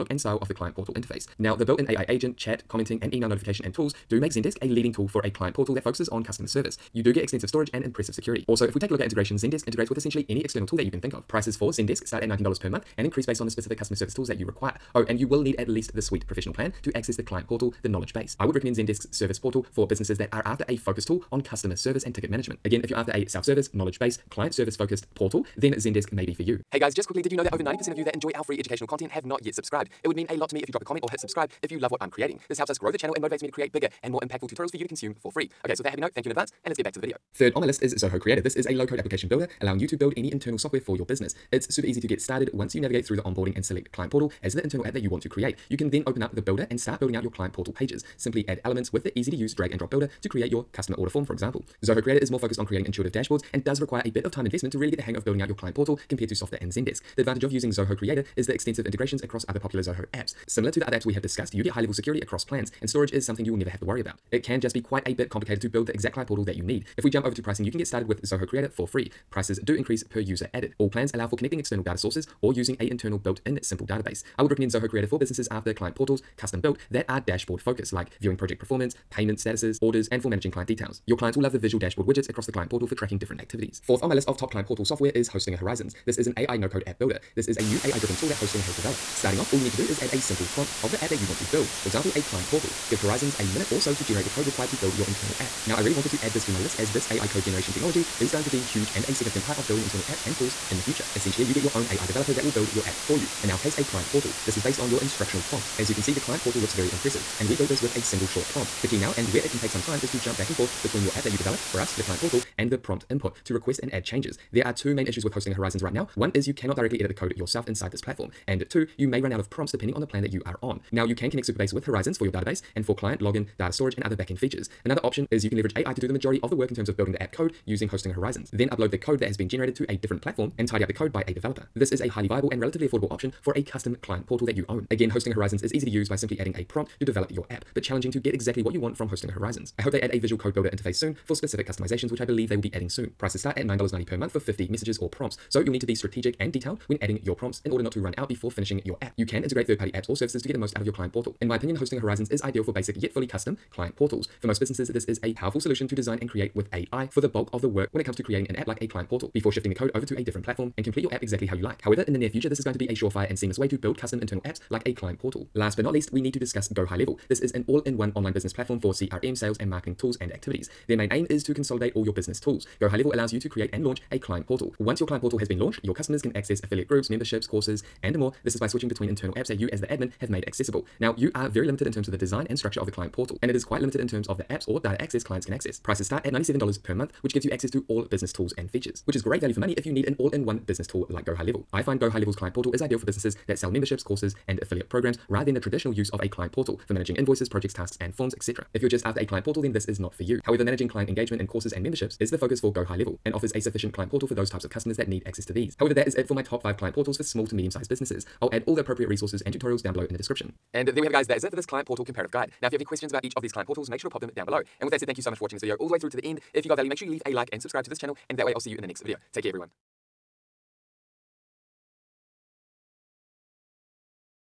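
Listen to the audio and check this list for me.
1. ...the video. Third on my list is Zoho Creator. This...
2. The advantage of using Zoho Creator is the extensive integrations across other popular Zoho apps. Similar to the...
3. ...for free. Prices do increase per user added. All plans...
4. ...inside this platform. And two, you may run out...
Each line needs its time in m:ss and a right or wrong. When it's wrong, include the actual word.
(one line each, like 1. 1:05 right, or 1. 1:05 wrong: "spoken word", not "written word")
1. 0:36 right
2. 0:57 right
3. 1:08 right
4. 1:57 right.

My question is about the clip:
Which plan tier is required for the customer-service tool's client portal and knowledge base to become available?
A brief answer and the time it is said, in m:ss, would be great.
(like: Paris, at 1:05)
Suite Professional, at 0:16.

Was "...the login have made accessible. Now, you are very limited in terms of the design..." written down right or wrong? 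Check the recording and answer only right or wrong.
wrong.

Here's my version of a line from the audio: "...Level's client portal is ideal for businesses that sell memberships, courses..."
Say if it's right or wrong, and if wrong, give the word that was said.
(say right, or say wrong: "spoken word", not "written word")
right.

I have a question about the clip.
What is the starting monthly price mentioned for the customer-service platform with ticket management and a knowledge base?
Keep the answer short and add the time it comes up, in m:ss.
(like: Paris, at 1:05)
$19, at 0:12.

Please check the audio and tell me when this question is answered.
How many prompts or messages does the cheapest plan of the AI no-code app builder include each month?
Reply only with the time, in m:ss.
2:24.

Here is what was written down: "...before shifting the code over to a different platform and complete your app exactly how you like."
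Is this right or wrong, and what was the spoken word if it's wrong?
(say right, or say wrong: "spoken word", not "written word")
right.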